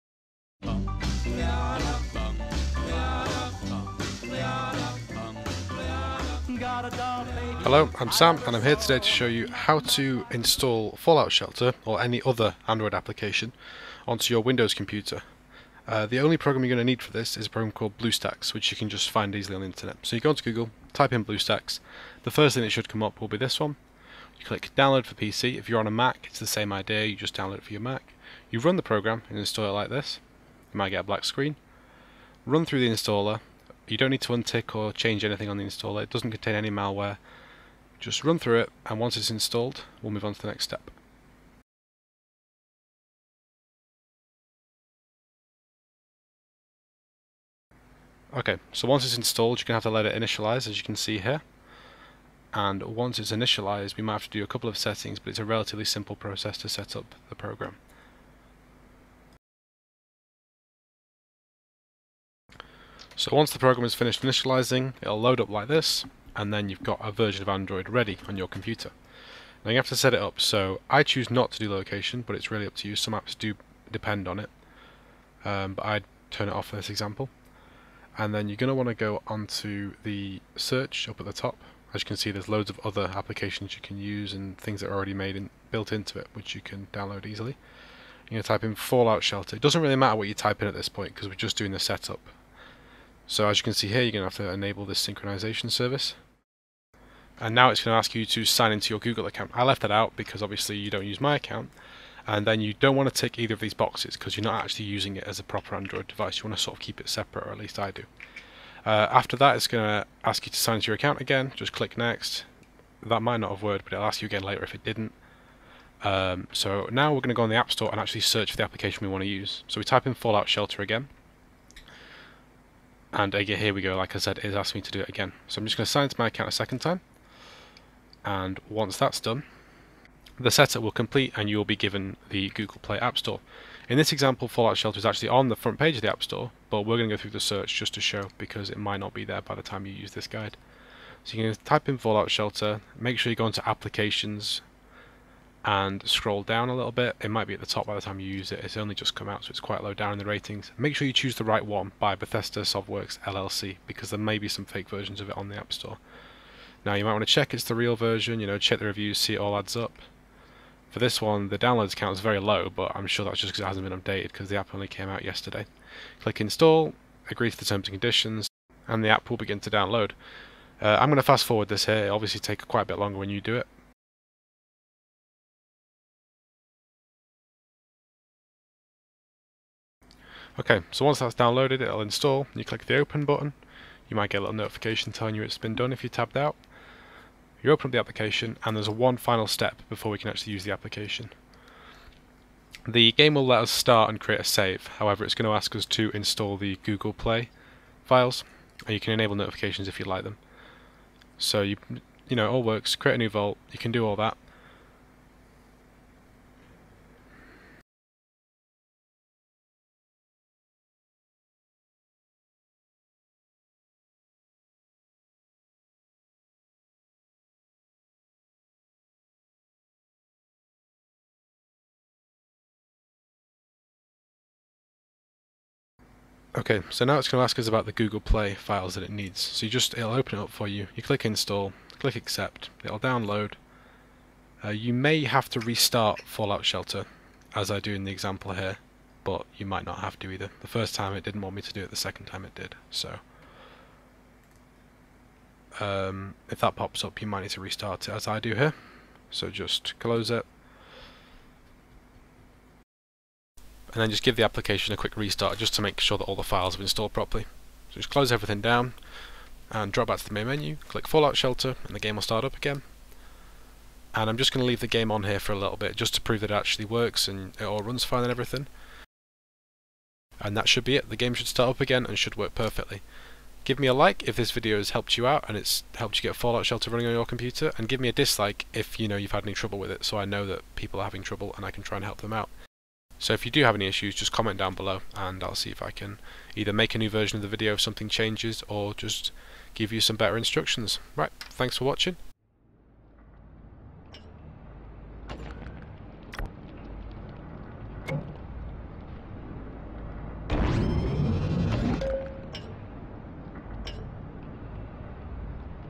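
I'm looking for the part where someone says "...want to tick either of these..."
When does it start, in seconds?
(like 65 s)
102 s.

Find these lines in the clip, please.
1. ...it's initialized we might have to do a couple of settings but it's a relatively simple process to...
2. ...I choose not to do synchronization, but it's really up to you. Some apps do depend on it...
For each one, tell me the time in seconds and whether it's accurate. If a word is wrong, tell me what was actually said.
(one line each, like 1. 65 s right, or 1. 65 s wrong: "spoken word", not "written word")
1. 53 s right
2. 70 s wrong: "location", not "synchronization".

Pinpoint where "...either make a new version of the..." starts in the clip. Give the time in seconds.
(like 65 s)
286 s.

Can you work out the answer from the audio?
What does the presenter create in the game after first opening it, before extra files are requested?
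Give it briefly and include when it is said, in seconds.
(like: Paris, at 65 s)
A new vault, at 203 s.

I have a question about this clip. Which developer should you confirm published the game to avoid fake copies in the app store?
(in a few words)
Bethesda Softworks LLC.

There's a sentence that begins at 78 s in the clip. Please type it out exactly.
And then you're going to want to go onto the search up at the top.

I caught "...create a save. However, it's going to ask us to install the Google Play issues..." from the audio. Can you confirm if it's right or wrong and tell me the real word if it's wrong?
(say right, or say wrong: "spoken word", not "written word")
wrong: "files", not "issues".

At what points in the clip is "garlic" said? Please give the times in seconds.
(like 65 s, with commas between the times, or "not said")
not said.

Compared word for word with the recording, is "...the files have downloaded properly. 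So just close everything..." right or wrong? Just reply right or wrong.
wrong.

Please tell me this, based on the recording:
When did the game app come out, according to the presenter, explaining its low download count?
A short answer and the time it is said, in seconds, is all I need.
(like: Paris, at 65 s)
Yesterday, at 165 s.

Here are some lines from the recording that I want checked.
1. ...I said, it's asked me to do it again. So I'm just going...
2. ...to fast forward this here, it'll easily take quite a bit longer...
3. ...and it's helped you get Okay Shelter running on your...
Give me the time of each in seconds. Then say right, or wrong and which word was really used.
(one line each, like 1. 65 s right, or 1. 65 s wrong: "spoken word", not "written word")
1. 124 s right
2. 171 s wrong: "obviously", not "easily"
3. 275 s wrong: "Fallout", not "Okay".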